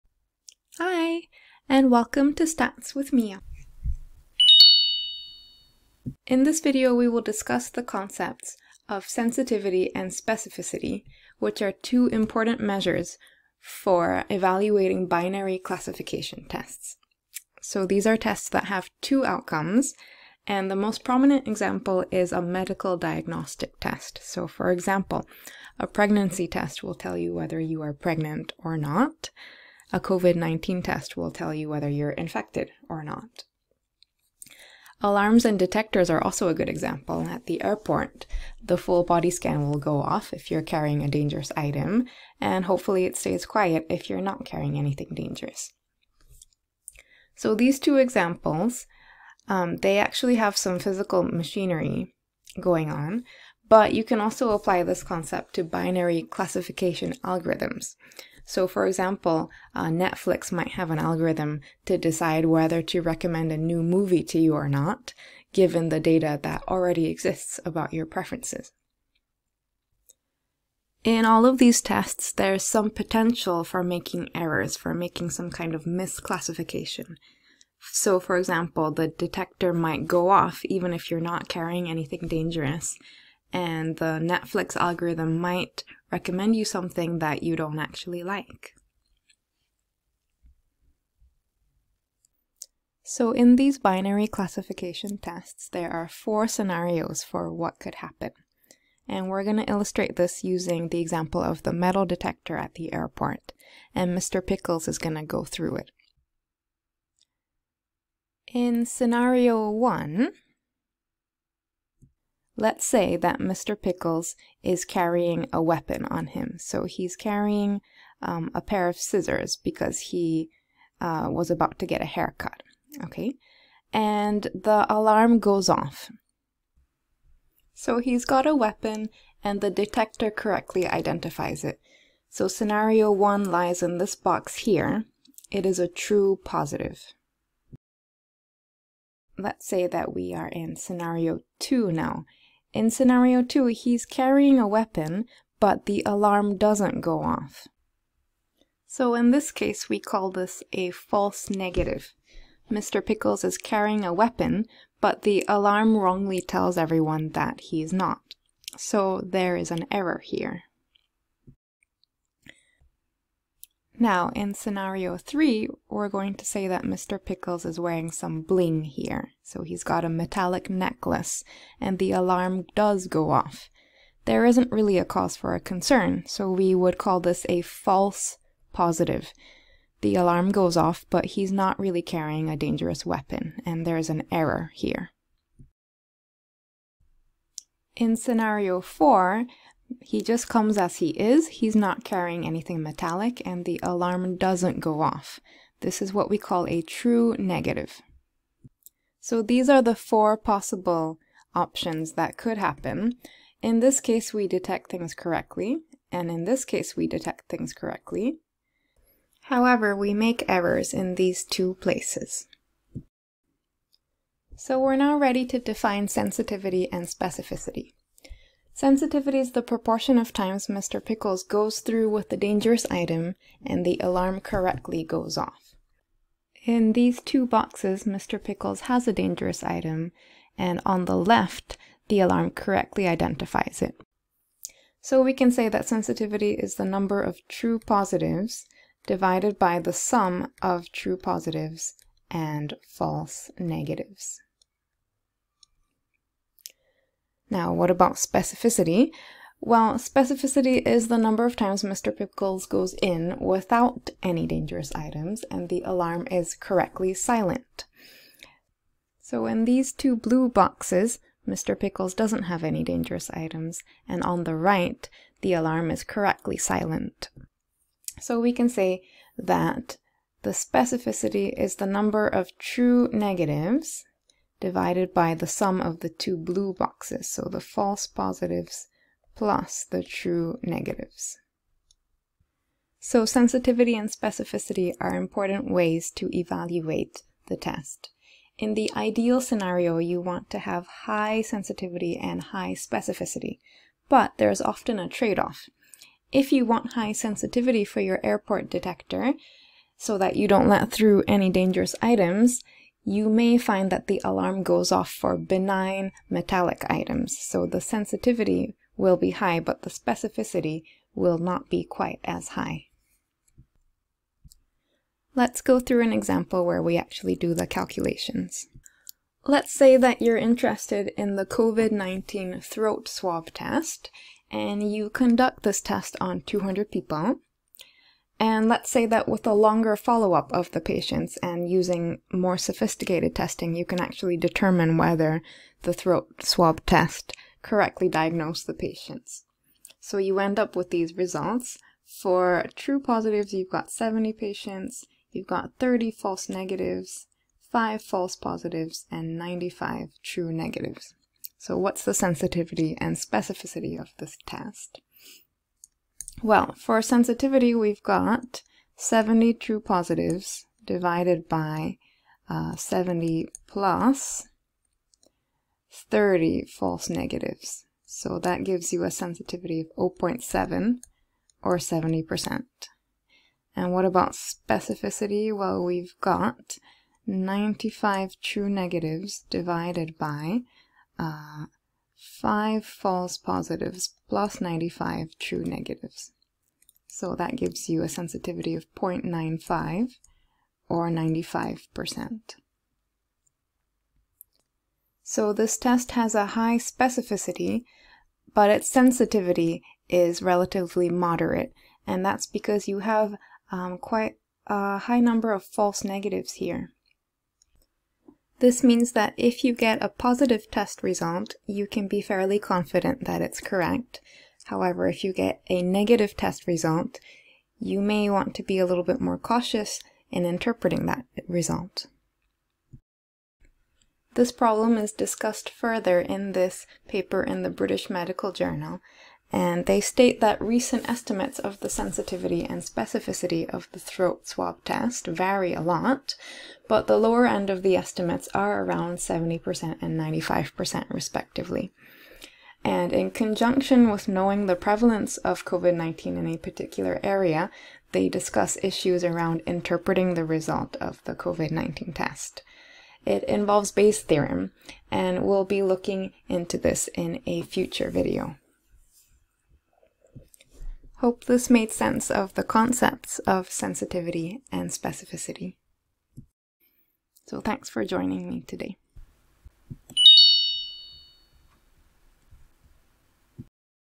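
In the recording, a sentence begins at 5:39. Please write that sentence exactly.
So you end up with these results.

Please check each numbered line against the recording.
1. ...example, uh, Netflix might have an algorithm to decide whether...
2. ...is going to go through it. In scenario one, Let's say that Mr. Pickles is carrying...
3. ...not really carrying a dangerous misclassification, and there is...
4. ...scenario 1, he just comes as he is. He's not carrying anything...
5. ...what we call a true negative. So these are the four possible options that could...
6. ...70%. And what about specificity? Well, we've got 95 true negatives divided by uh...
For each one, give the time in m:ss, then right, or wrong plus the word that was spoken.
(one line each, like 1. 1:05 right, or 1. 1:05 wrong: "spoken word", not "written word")
1. 0:58 right
2. 1:44 right
3. 3:01 wrong: "weapon", not "misclassification"
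4. 3:08 wrong: "4", not "1"
5. 3:16 right
6. 6:11 right.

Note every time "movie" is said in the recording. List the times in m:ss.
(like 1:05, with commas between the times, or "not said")
1:03.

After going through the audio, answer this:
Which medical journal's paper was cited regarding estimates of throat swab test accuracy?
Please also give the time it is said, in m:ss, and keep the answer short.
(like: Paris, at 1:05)
British Medical Journal, at 7:07.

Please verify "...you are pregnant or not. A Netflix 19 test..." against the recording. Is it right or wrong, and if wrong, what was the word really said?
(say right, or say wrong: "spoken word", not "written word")
wrong: "COVID", not "Netflix".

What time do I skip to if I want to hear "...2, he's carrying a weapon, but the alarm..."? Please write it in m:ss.
2:23.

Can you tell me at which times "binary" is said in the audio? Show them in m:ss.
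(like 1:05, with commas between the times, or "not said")
0:15, 0:55, 1:33.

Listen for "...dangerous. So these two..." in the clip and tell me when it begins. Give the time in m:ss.
0:45.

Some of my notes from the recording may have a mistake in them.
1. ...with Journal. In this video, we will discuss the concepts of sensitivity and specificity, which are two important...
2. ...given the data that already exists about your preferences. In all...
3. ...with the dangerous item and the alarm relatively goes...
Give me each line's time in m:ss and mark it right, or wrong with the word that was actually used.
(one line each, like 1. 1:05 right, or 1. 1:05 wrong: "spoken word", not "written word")
1. 0:02 wrong: "Mia", not "Journal"
2. 1:05 right
3. 3:42 wrong: "correctly", not "relatively".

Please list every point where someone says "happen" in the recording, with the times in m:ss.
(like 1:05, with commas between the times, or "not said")
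1:37, 3:22.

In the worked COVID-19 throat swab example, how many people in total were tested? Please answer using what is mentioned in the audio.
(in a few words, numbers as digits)
200.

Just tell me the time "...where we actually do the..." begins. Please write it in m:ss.
5:16.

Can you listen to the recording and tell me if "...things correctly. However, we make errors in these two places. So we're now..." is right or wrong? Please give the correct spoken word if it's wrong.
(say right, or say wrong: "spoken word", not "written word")
right.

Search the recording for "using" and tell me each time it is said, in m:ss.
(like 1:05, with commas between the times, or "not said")
1:40, 5:31.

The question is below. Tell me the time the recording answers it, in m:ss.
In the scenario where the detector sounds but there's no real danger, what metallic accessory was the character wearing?
2:50.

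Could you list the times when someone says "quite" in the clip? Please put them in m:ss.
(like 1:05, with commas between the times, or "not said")
5:11, 6:43.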